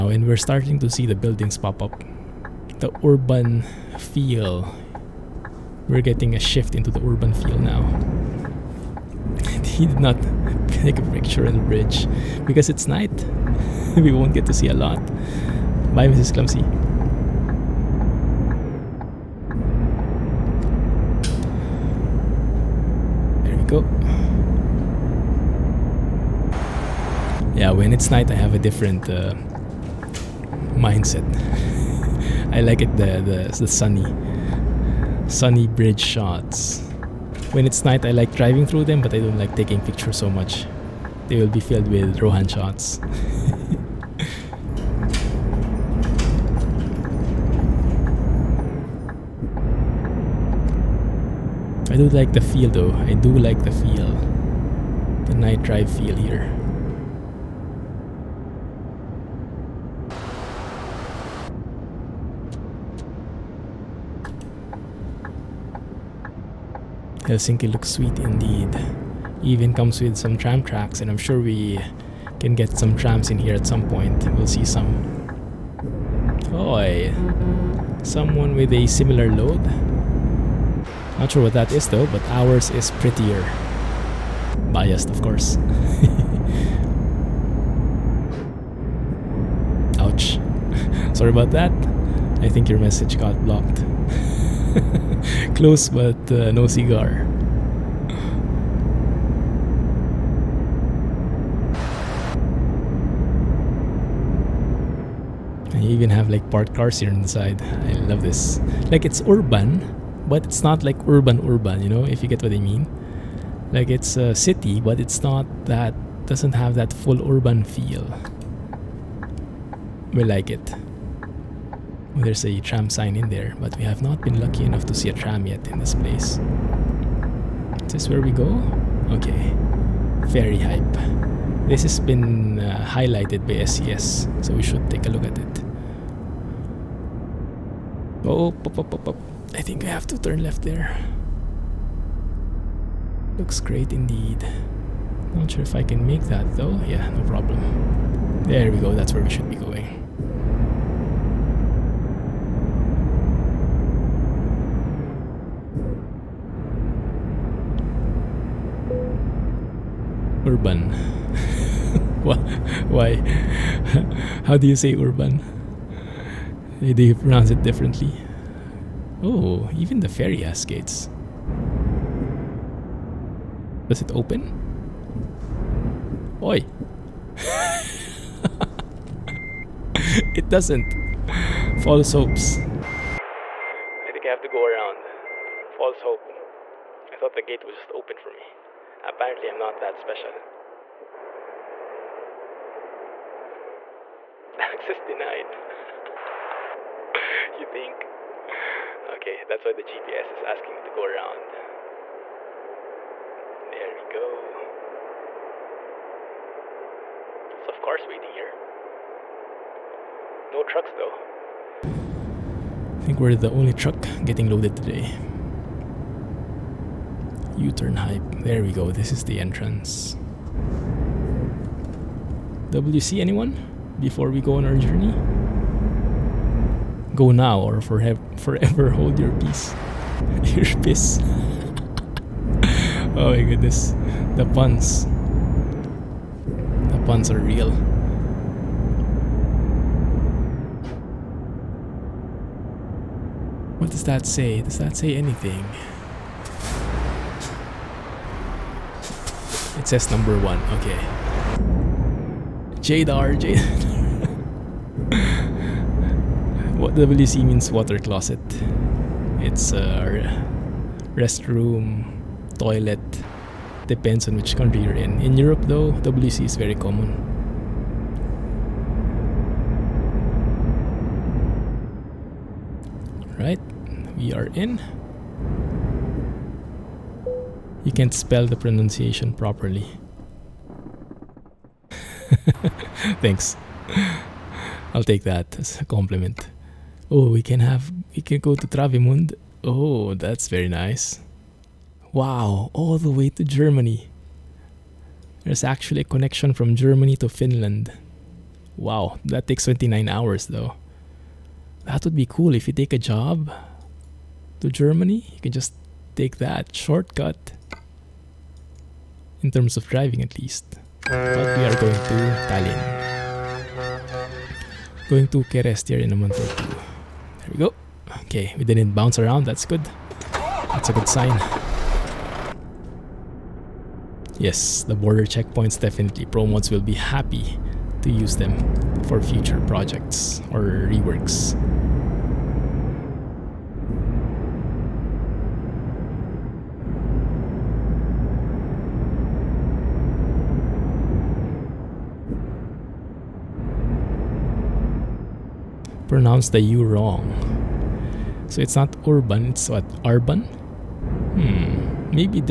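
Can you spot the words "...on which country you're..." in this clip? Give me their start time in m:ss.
4:24.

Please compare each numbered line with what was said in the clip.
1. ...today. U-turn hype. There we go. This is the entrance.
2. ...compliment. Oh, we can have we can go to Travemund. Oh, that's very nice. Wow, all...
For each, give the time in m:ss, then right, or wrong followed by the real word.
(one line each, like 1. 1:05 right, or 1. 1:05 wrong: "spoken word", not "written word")
1. 3:34 right
2. 4:45 right.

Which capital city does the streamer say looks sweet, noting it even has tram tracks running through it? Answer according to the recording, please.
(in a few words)
Helsinki.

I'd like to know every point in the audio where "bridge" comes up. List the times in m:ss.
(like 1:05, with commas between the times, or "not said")
0:11, 0:35.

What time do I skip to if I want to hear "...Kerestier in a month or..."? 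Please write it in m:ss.
5:15.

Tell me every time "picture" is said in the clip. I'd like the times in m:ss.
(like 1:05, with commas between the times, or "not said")
0:11, 0:39.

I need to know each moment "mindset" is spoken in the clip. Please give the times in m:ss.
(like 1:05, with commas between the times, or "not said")
0:30.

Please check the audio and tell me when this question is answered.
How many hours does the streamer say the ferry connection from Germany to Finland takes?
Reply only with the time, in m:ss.
4:59.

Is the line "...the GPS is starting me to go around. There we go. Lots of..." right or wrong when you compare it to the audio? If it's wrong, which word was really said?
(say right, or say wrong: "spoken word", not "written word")
wrong: "asking", not "starting".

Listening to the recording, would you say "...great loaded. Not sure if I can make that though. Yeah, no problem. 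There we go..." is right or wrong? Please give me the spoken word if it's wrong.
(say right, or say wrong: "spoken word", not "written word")
wrong: "indeed", not "loaded".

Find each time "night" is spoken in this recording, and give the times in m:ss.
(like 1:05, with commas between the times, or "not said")
0:12, 0:28, 0:37, 0:55.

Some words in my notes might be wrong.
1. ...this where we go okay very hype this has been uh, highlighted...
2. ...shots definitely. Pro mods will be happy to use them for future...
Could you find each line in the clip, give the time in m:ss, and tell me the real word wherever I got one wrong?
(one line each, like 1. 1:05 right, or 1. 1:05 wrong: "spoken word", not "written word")
1. 2:07 right
2. 5:25 wrong: "checkpoints", not "shots".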